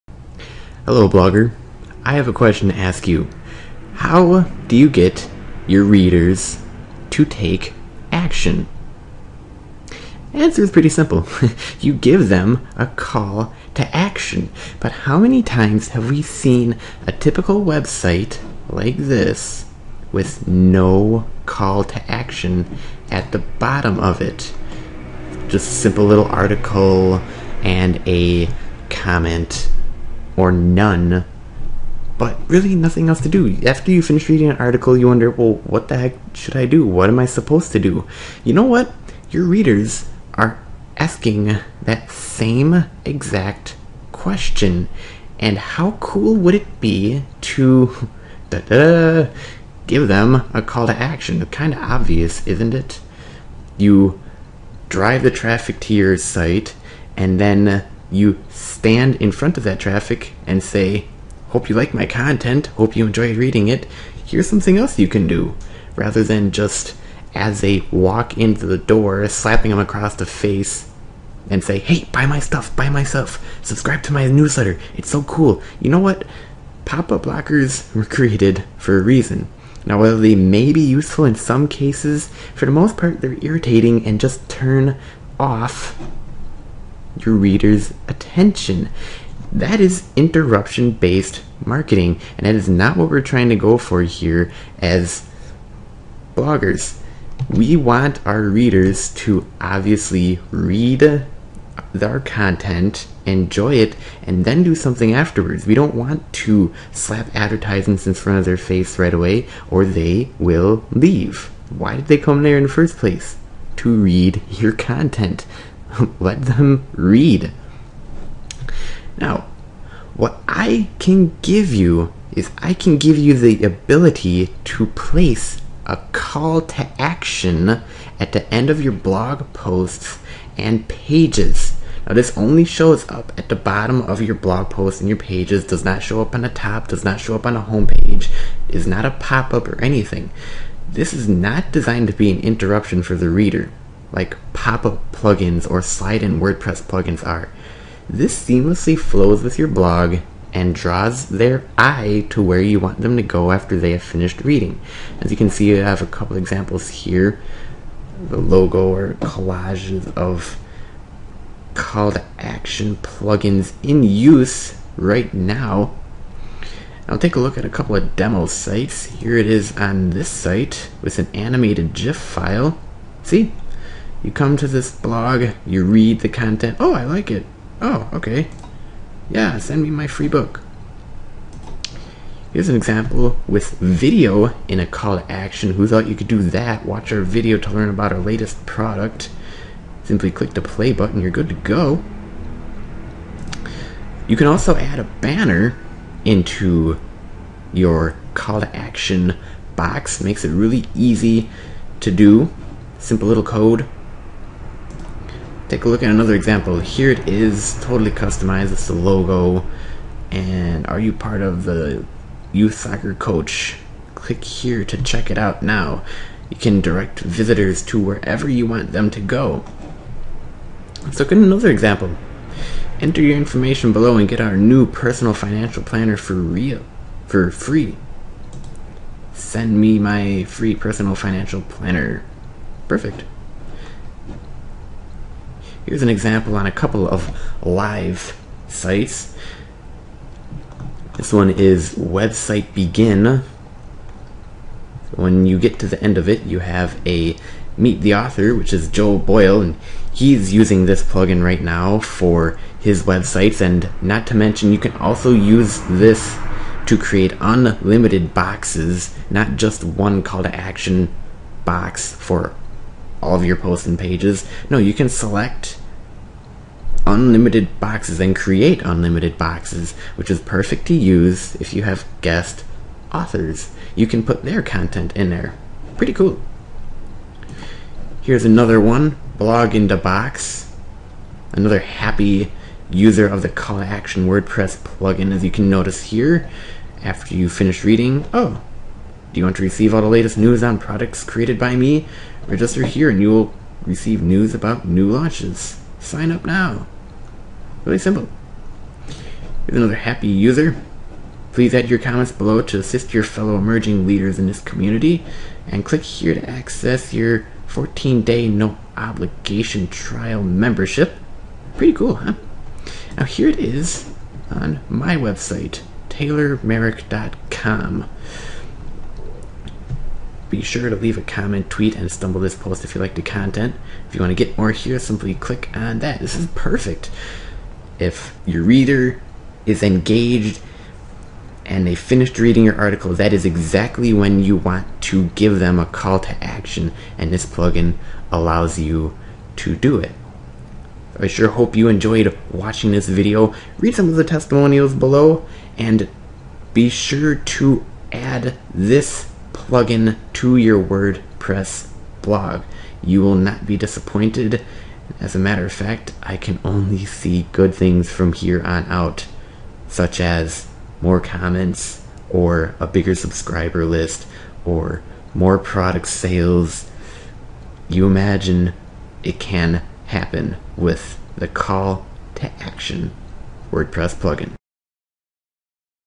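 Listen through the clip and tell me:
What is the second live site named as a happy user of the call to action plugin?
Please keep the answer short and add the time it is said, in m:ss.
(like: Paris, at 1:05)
Blog in the Box, at 4:39.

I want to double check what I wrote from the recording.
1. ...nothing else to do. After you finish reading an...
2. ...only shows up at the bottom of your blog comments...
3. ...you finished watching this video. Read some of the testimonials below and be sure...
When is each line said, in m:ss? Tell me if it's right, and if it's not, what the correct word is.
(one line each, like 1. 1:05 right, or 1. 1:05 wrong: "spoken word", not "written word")
1. 0:32 right
2. 2:12 wrong: "posts", not "comments"
3. 5:41 wrong: "enjoyed", not "finished".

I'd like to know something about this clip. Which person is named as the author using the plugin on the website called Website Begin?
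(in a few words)
Joe Boyle.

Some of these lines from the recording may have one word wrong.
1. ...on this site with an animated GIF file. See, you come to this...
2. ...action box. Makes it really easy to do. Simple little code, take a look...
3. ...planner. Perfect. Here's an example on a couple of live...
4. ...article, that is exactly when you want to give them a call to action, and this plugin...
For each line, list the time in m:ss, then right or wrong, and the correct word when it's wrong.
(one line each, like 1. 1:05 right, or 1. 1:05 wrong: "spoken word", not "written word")
1. 2:49 right
2. 3:18 right
3. 3:51 right
4. 5:32 right.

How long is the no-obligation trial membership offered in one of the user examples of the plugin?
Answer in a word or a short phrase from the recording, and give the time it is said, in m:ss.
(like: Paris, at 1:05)
14 day, at 5:07.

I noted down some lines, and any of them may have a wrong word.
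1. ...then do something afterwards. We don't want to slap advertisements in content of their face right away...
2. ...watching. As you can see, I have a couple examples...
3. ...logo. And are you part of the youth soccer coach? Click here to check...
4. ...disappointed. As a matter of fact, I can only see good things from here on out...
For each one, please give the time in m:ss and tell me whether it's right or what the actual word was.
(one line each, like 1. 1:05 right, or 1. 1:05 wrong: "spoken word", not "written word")
1. 1:44 wrong: "front", not "content"
2. 2:34 wrong: "reading", not "watching"
3. 3:28 right
4. 5:53 right.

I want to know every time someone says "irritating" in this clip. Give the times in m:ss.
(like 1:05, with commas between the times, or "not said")
1:23.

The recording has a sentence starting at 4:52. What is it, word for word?
Register here and you will receive news about new launches.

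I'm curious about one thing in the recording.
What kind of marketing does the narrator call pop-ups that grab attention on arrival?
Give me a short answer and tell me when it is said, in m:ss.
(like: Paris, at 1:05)
interruption based marketing, at 1:30.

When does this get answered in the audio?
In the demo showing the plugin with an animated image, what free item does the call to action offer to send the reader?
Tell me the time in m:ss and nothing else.
3:00.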